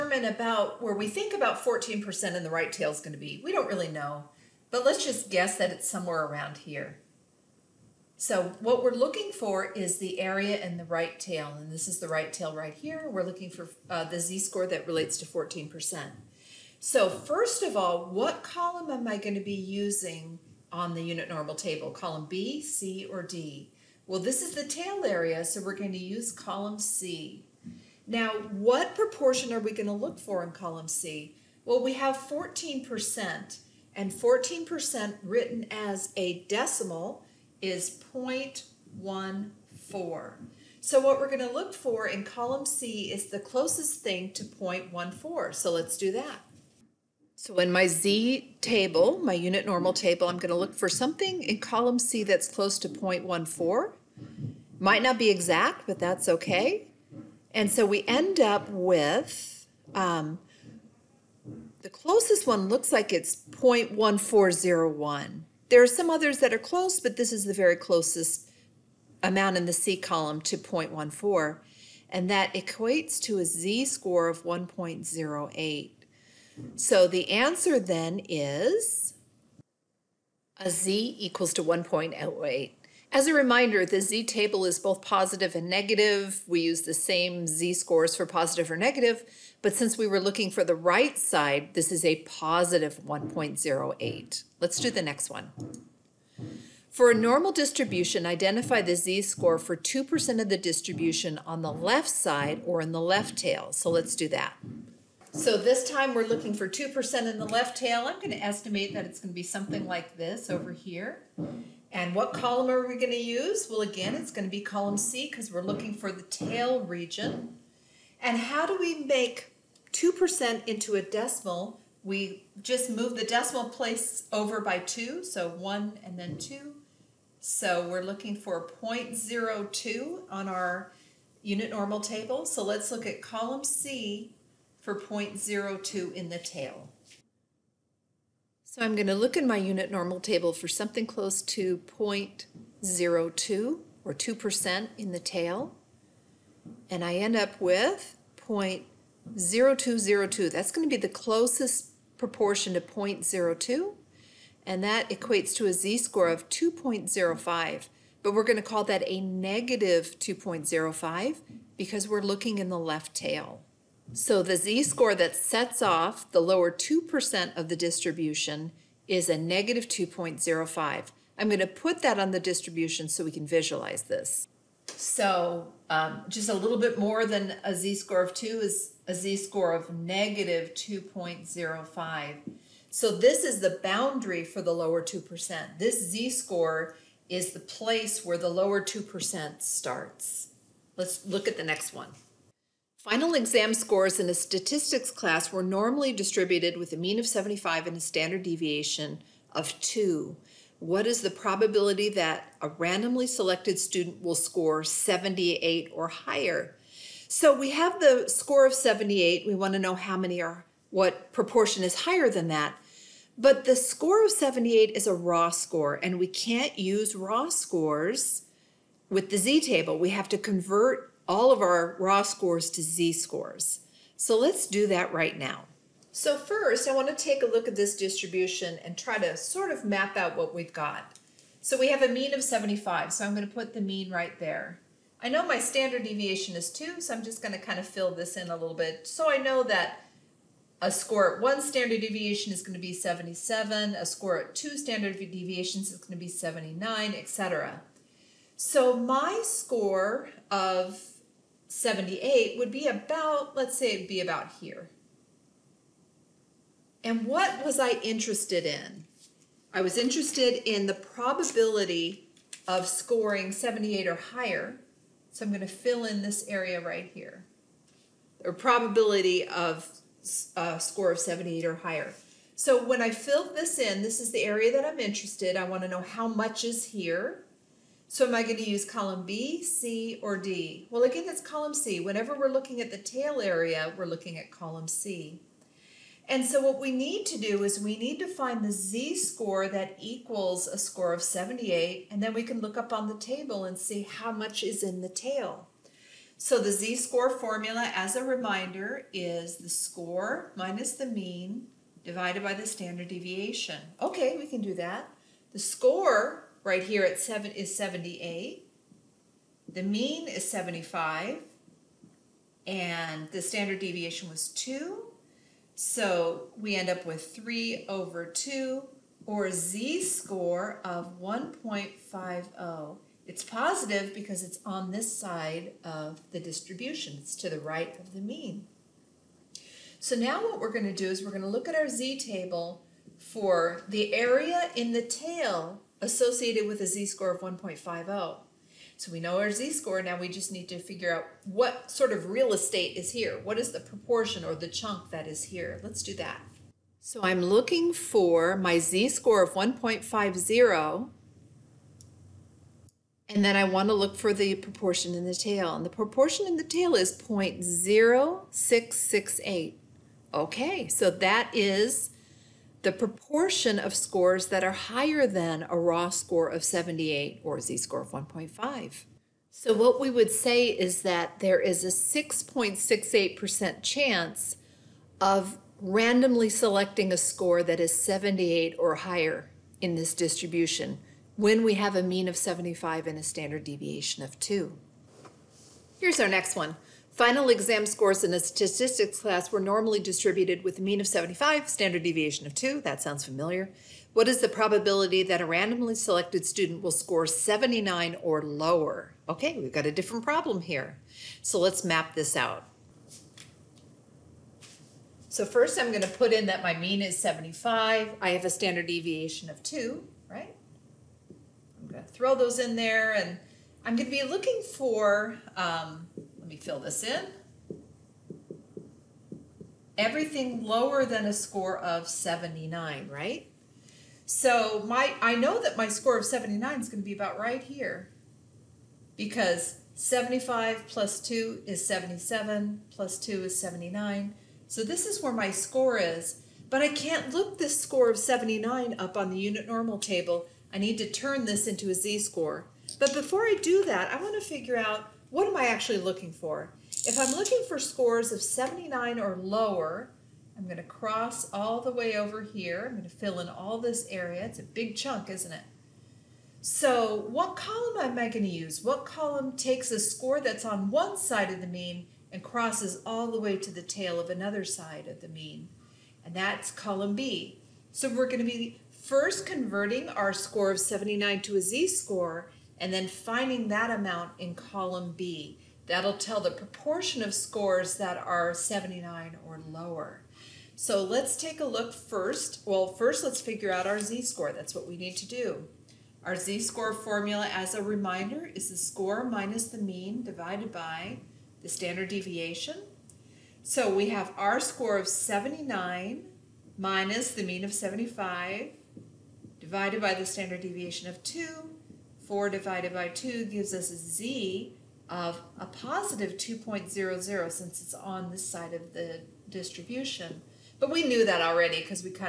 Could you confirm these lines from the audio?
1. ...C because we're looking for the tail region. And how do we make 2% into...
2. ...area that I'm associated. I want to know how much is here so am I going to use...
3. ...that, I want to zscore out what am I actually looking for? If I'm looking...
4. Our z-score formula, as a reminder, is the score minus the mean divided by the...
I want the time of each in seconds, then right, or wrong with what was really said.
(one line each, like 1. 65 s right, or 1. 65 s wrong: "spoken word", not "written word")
1. 114 s right
2. 274 s wrong: "interested", not "associated"
3. 443 s wrong: "figure", not "zscore"
4. 486 s right.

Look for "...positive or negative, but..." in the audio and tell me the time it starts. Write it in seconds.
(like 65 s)
88 s.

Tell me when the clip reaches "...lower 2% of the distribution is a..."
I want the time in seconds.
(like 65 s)
166 s.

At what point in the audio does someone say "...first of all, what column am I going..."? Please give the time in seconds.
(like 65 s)
17 s.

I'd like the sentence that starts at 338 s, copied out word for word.
So we know our z-score, now we just need to figure out what sort of real estate is here.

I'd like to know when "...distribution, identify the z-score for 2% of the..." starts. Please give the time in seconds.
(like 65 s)
97 s.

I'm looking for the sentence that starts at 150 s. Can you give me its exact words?
That's going to be the closest proportion to 0.02.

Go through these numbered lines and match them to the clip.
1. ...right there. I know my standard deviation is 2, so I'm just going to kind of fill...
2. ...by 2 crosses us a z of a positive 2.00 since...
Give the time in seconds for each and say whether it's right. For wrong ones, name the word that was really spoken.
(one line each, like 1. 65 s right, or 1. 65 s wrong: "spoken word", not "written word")
1. 234 s right
2. 502 s wrong: "gives", not "crosses".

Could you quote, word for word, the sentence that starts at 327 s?
It's to the right of the mean.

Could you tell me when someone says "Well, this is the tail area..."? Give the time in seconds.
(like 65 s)
24 s.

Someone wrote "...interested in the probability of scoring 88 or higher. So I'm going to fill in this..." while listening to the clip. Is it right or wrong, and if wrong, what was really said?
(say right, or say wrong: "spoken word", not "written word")
wrong: "78", not "88".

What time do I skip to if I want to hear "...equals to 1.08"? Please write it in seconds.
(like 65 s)
81 s.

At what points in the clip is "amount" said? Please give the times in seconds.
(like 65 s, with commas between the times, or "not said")
69 s, 473 s.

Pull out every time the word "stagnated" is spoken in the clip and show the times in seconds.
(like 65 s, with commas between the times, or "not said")
not said.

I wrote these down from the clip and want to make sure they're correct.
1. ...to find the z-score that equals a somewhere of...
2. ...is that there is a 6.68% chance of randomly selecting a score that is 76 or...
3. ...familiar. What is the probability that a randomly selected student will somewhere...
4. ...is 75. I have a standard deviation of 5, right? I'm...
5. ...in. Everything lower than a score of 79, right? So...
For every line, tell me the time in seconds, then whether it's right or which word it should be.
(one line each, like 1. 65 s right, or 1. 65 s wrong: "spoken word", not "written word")
1. 288 s wrong: "score", not "somewhere"
2. 370 s wrong: "78", not "76"
3. 393 s wrong: "score", not "somewhere"
4. 407 s wrong: "2", not "5"
5. 417 s right.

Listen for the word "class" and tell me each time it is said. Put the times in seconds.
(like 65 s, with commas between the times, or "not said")
195 s, 389 s.